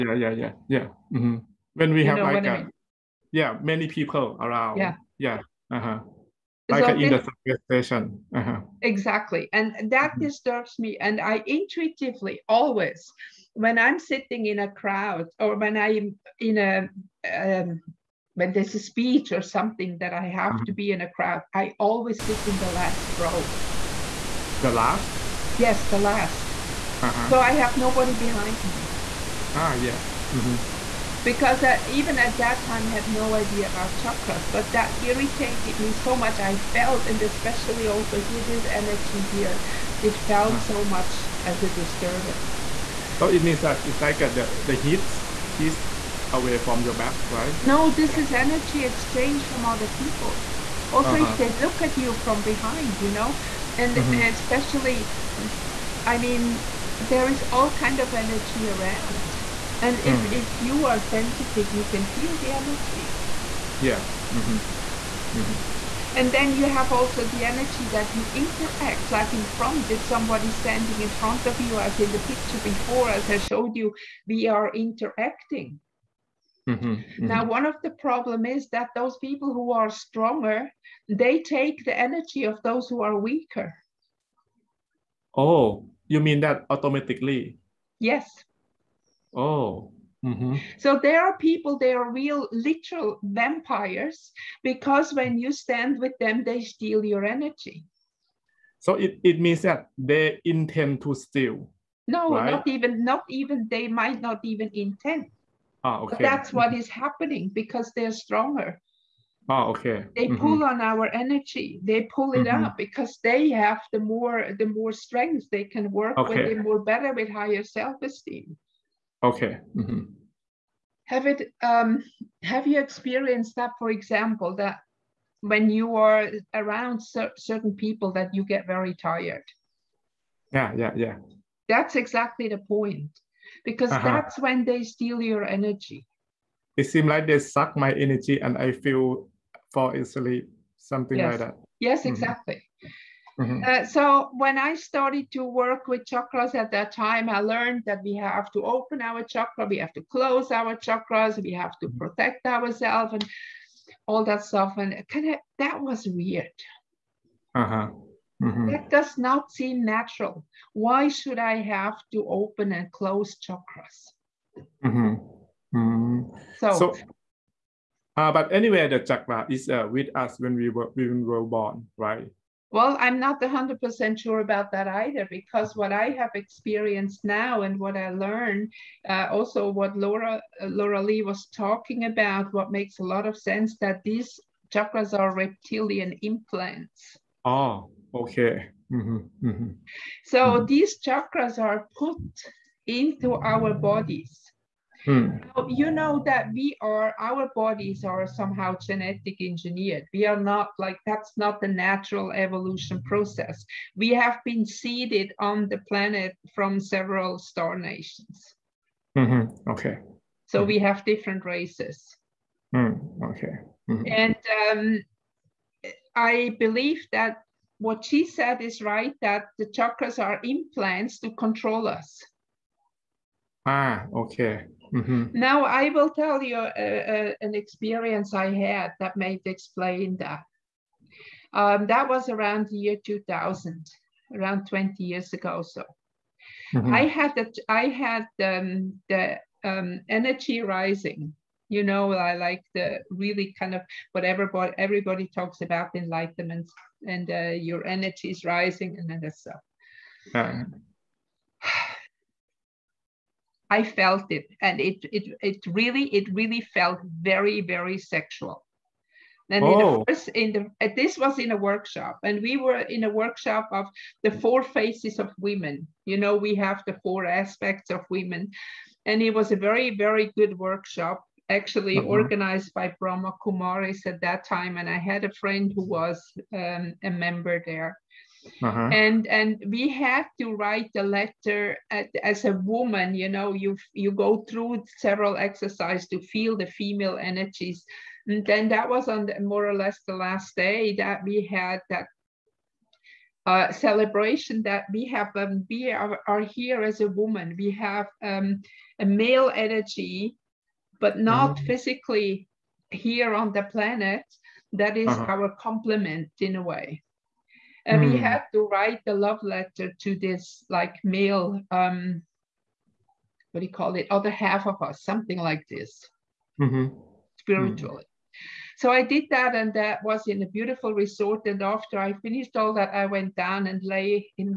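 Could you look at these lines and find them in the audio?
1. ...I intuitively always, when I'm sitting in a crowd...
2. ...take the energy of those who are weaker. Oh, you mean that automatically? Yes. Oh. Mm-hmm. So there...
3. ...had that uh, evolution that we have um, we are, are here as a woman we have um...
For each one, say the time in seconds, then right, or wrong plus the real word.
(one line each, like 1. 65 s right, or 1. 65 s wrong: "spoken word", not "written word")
1. 11 s right
2. 81 s right
3. 291 s wrong: "celebration", not "evolution".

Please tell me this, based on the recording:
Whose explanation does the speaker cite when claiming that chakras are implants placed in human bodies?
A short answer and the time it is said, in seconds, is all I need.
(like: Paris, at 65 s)
Laura Lee, at 180 s.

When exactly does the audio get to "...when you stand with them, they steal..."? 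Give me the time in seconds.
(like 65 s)
95 s.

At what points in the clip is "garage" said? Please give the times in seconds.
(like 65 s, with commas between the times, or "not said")
not said.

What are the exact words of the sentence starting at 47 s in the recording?
No, this is energy exchange from other people.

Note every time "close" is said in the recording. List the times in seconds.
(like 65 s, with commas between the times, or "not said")
150 s, 162 s.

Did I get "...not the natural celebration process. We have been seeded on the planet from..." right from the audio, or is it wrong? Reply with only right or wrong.
wrong.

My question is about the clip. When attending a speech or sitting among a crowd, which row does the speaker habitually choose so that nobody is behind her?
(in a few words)
The last row.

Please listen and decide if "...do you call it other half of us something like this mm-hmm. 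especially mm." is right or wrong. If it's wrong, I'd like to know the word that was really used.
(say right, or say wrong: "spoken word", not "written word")
wrong: "spiritually", not "especially".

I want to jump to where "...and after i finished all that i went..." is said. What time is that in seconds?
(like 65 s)
321 s.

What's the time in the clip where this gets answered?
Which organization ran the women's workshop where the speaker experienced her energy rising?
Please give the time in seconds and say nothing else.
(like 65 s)
272 s.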